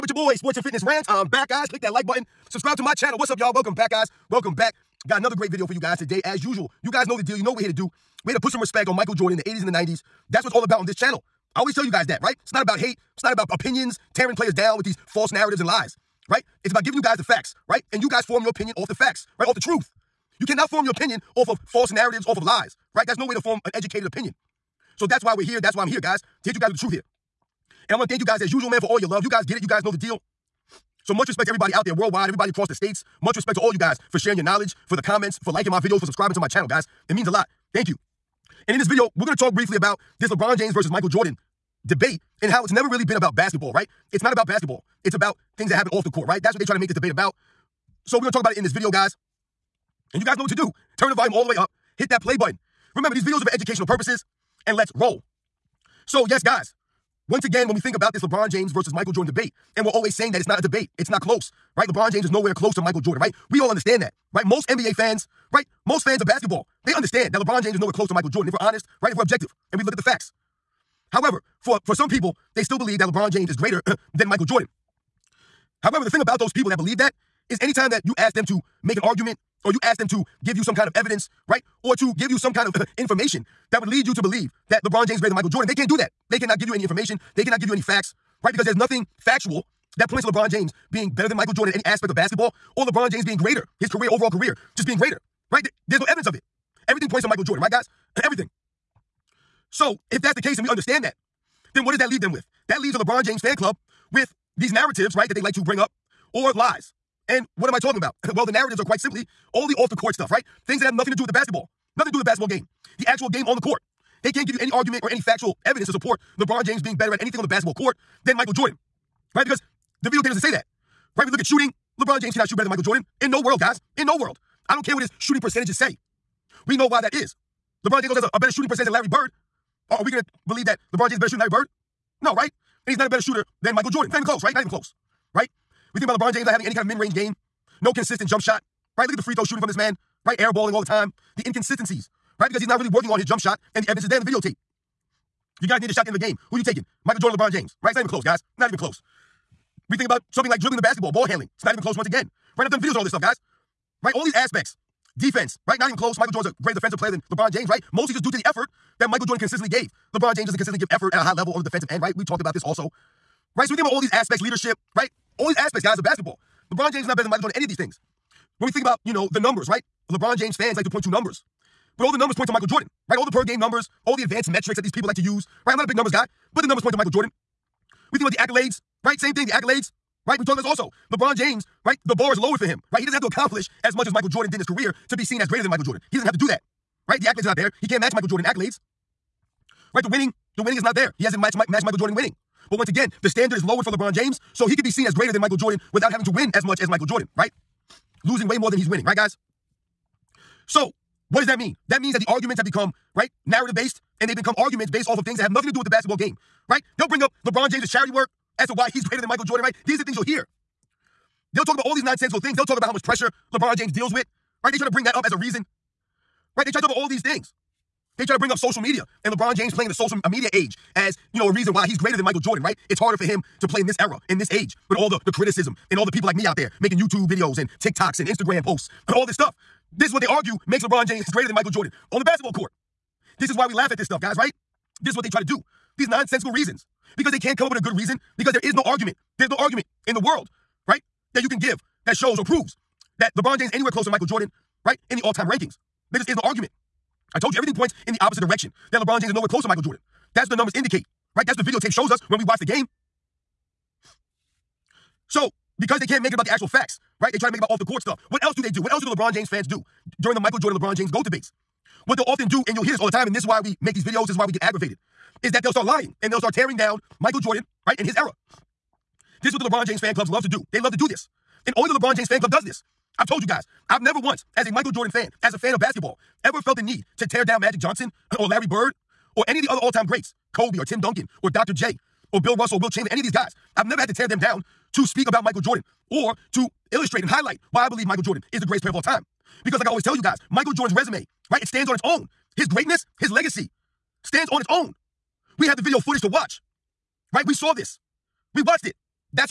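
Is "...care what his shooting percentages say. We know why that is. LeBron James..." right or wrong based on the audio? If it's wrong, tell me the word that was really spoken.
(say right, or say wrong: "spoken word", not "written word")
right.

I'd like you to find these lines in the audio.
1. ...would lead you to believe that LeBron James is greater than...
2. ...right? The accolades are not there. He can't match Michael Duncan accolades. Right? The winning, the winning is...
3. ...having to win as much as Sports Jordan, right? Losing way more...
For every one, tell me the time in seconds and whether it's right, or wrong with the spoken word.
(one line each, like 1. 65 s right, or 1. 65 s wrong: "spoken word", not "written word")
1. 83 s right
2. 187 s wrong: "Jordan", not "Duncan"
3. 196 s wrong: "Michael", not "Sports".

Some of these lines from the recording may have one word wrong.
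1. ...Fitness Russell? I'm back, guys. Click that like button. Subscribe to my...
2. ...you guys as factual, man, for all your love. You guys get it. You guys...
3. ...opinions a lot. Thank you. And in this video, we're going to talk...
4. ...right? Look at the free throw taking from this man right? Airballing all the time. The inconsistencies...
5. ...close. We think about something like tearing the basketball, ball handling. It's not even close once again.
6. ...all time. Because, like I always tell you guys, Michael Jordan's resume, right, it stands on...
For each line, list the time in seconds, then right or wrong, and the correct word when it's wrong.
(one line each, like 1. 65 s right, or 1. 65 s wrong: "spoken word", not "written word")
1. 0 s wrong: "Rants", not "Russell"
2. 28 s wrong: "usual", not "factual"
3. 37 s wrong: "means", not "opinions"
4. 138 s wrong: "shooting", not "taking"
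5. 148 s wrong: "dribbling", not "tearing"
6. 288 s right.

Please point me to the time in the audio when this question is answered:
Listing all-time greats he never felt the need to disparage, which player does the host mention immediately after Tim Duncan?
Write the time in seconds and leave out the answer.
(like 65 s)
281 s.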